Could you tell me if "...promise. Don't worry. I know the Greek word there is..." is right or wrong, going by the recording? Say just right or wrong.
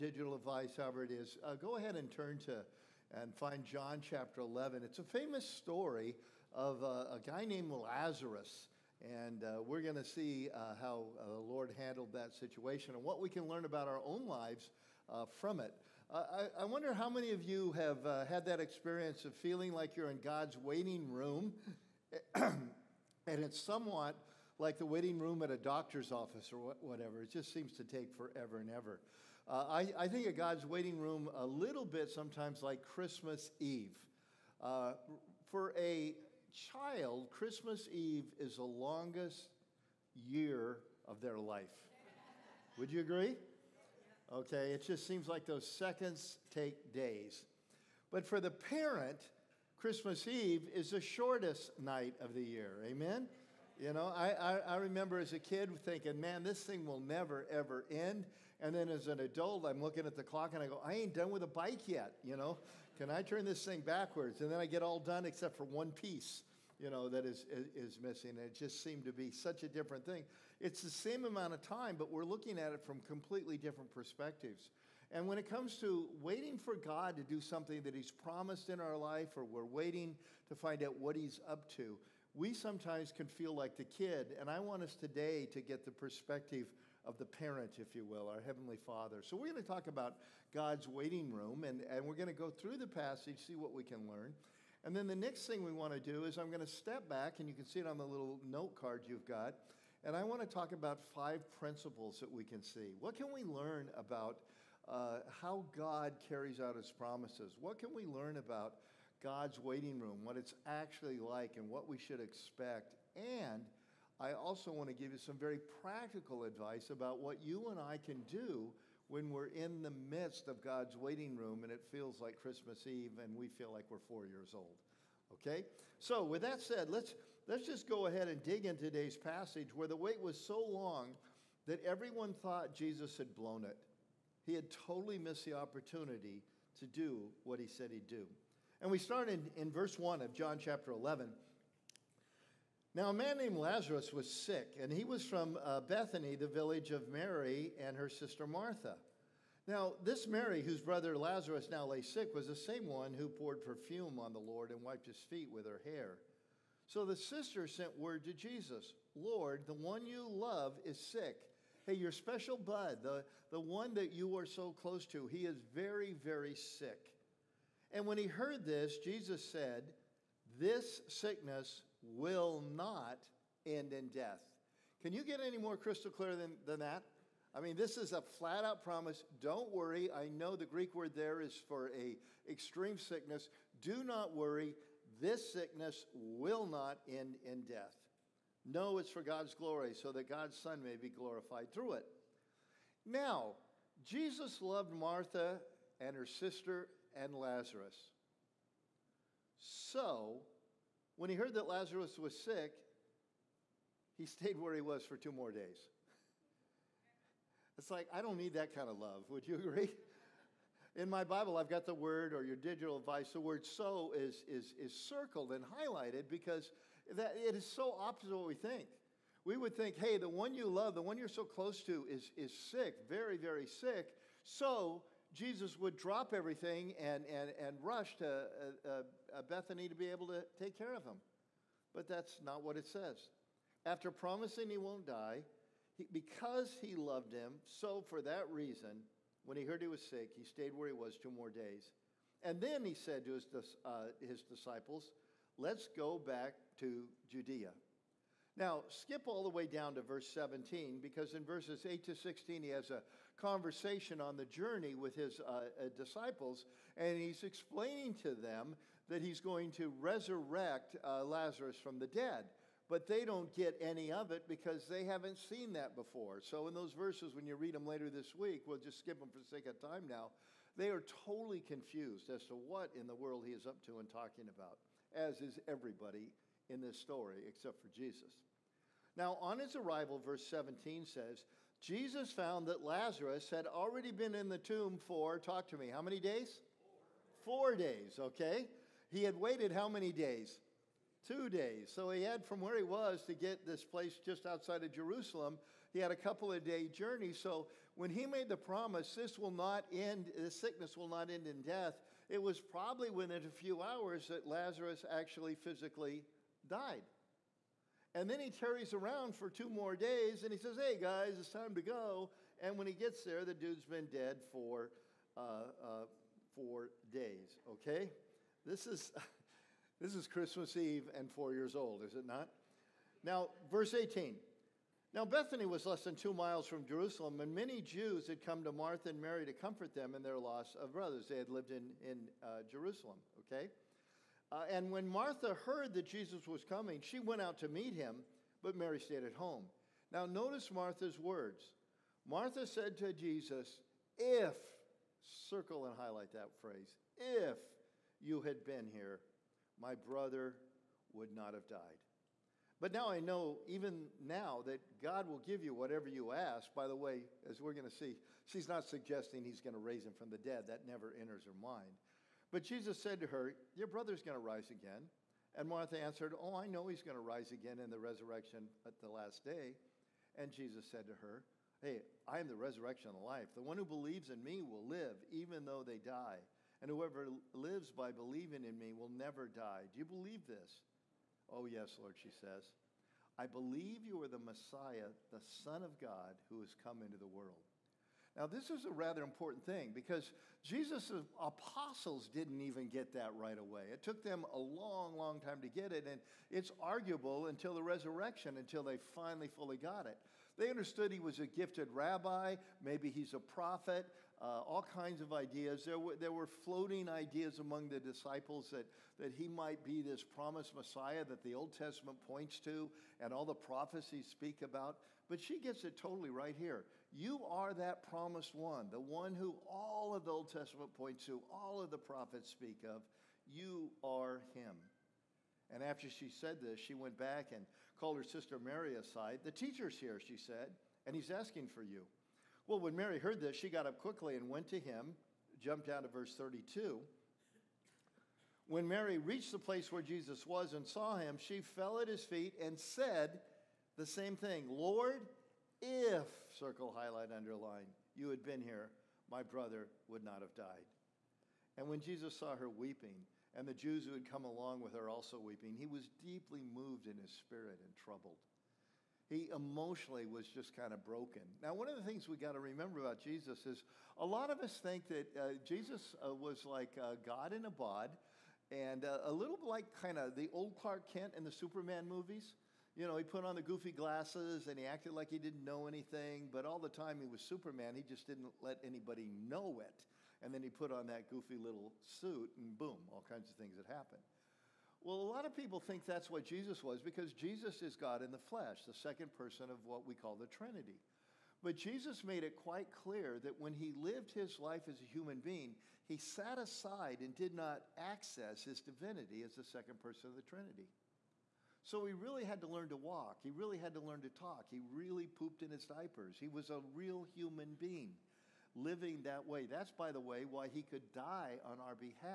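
right.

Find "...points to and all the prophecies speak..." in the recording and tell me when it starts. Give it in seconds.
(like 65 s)
412 s.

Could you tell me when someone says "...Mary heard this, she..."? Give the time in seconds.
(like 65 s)
432 s.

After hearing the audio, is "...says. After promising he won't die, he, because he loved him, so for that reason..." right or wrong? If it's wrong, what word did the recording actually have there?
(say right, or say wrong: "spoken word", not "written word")
right.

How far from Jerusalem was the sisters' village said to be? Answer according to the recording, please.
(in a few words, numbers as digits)
Less than 2 miles.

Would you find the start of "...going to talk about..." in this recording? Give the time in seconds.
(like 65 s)
89 s.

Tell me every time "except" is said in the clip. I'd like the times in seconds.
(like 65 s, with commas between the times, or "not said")
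65 s, 277 s.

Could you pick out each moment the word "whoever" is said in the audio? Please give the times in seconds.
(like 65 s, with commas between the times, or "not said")
376 s.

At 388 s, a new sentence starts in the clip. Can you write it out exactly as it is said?
Now, this is a rather important thing because Jesus' apostles didn't even get that right away.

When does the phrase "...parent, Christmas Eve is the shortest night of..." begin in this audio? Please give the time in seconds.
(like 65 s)
48 s.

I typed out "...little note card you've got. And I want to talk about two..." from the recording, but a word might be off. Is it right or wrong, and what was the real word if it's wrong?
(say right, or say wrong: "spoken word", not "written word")
wrong: "five", not "two".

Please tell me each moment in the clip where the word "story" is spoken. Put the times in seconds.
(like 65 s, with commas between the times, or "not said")
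5 s, 276 s.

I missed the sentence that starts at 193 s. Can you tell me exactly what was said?
Now, Jesus loved Martha and her sister and Lazarus.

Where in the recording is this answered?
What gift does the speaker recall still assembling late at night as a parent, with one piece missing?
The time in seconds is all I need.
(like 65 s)
61 s.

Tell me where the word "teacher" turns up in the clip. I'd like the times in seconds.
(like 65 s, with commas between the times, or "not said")
429 s.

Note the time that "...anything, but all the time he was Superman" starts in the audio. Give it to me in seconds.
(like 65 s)
475 s.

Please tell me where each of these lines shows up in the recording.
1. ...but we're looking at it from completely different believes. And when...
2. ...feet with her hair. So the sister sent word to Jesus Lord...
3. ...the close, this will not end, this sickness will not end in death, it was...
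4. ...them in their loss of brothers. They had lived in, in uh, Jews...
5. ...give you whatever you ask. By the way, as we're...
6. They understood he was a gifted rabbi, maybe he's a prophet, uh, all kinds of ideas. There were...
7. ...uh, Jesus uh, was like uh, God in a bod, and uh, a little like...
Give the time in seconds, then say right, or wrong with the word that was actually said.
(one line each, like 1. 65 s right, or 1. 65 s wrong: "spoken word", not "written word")
1. 71 s wrong: "perspectives", not "believes"
2. 155 s right
3. 298 s wrong: "promise", not "close"
4. 329 s wrong: "Jerusalem", not "Jews"
5. 355 s right
6. 400 s right
7. 465 s right.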